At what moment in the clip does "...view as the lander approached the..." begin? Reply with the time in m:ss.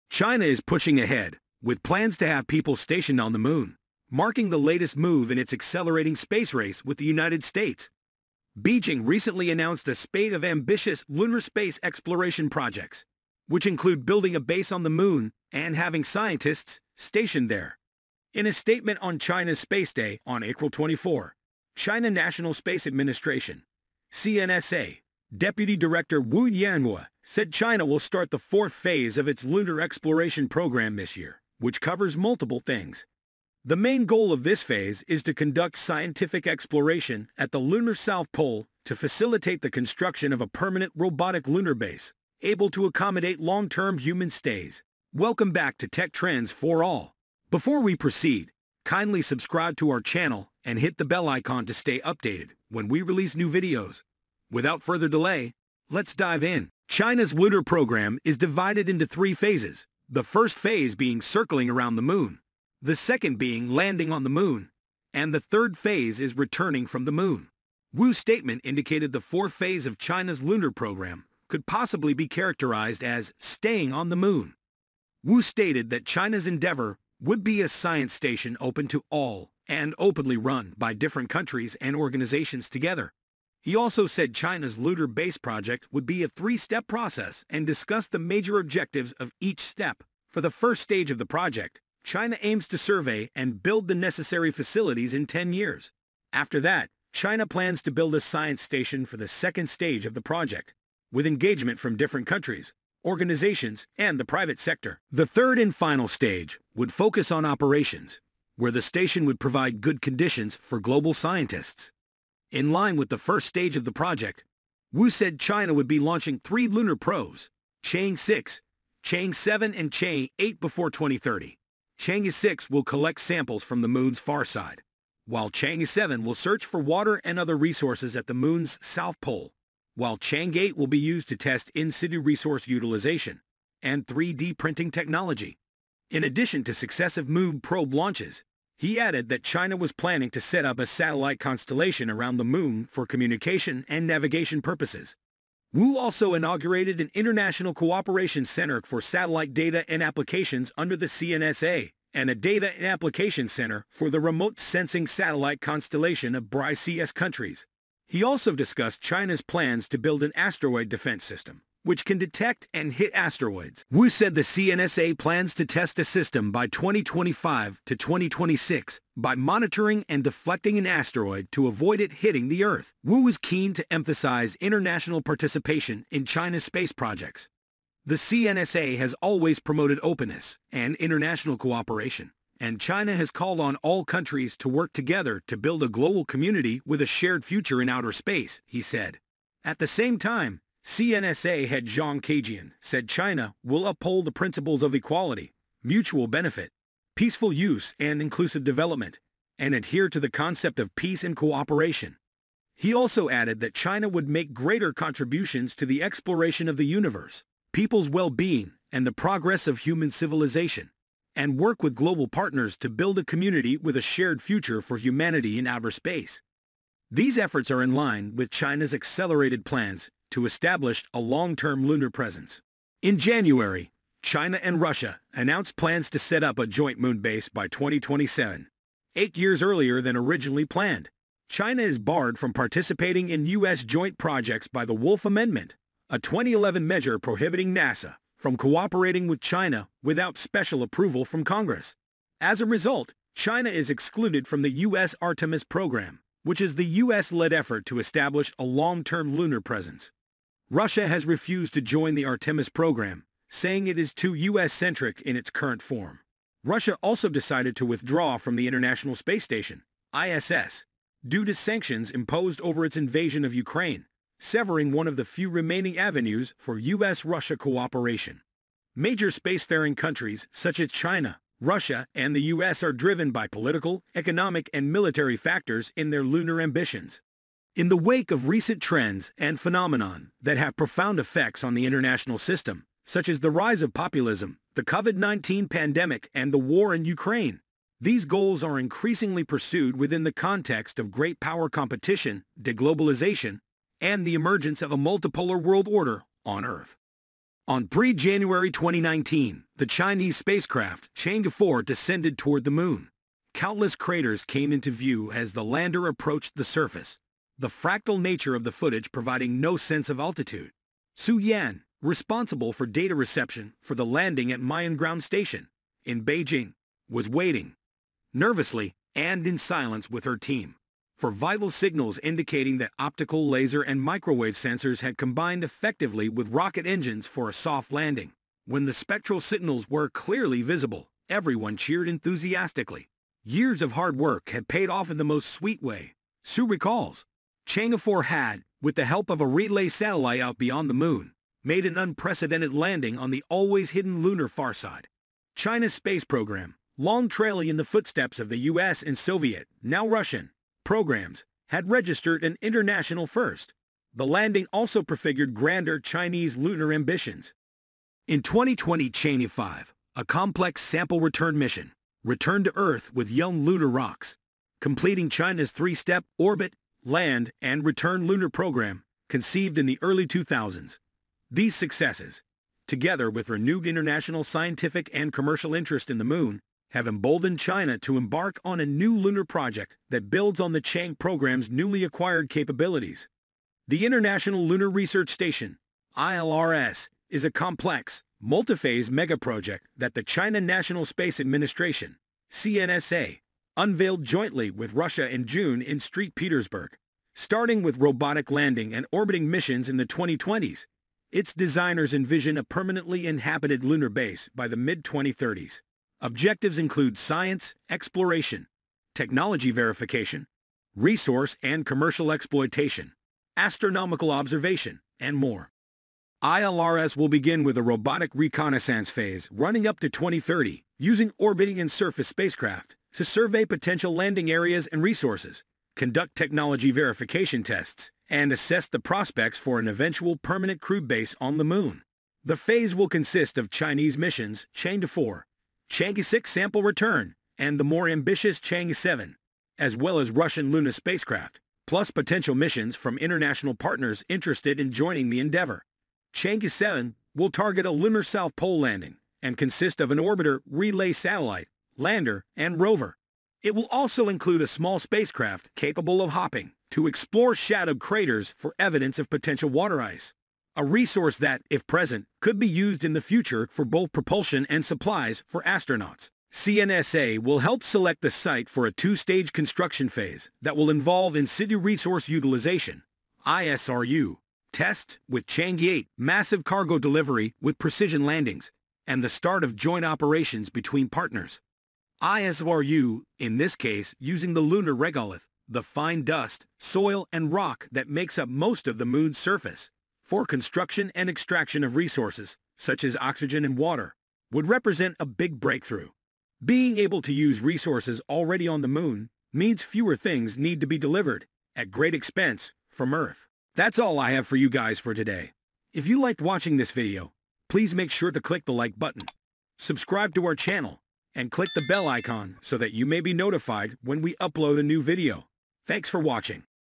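5:04.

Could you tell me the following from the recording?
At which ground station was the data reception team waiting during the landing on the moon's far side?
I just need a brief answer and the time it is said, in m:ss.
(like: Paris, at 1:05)
Miyun, at 5:14.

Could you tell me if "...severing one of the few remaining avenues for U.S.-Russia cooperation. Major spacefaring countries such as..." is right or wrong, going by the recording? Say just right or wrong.
right.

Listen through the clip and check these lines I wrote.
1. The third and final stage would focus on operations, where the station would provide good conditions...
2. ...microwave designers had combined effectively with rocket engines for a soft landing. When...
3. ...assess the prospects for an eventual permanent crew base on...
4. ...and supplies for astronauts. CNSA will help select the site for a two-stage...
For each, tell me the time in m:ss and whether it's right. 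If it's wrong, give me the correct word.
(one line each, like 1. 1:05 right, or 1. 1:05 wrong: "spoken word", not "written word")
1. 1:45 right
2. 5:24 wrong: "sensors", not "designers"
3. 7:08 right
4. 7:44 right.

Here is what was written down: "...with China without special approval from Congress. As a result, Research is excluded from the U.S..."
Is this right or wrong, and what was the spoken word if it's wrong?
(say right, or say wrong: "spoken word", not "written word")
wrong: "China", not "Research".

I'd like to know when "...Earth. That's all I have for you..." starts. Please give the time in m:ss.
8:23.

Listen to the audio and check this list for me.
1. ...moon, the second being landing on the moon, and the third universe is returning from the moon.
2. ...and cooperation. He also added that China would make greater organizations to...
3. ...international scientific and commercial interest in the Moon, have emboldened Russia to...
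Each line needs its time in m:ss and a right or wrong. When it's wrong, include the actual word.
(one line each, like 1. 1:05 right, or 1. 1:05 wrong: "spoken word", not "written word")
1. 1:02 wrong: "phase", not "universe"
2. 3:21 wrong: "contributions", not "organizations"
3. 6:13 wrong: "China", not "Russia".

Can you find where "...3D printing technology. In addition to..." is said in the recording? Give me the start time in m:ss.
2:14.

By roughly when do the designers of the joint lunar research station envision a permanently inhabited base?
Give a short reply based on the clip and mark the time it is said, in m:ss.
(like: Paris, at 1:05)
mid-2030s, at 6:44.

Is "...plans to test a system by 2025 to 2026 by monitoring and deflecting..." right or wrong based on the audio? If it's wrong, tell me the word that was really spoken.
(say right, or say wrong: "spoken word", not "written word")
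right.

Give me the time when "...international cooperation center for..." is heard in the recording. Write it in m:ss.
2:27.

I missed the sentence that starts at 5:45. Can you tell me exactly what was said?
China's space program, long trailing in the footsteps of the US and Soviet, now Russian, programs, had registered an international first.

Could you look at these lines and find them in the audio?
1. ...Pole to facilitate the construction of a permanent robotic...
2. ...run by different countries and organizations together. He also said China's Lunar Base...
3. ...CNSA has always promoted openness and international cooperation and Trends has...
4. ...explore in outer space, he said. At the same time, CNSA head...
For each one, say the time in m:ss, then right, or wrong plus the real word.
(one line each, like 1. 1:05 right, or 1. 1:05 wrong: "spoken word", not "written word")
1. 0:38 right
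2. 1:20 right
3. 2:58 wrong: "China", not "Trends"
4. 3:07 wrong: "future", not "explore".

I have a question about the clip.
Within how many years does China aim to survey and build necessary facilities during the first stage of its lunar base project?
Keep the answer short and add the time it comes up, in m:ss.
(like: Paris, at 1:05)
10 years, at 1:35.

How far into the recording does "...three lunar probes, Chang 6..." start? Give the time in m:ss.
1:56.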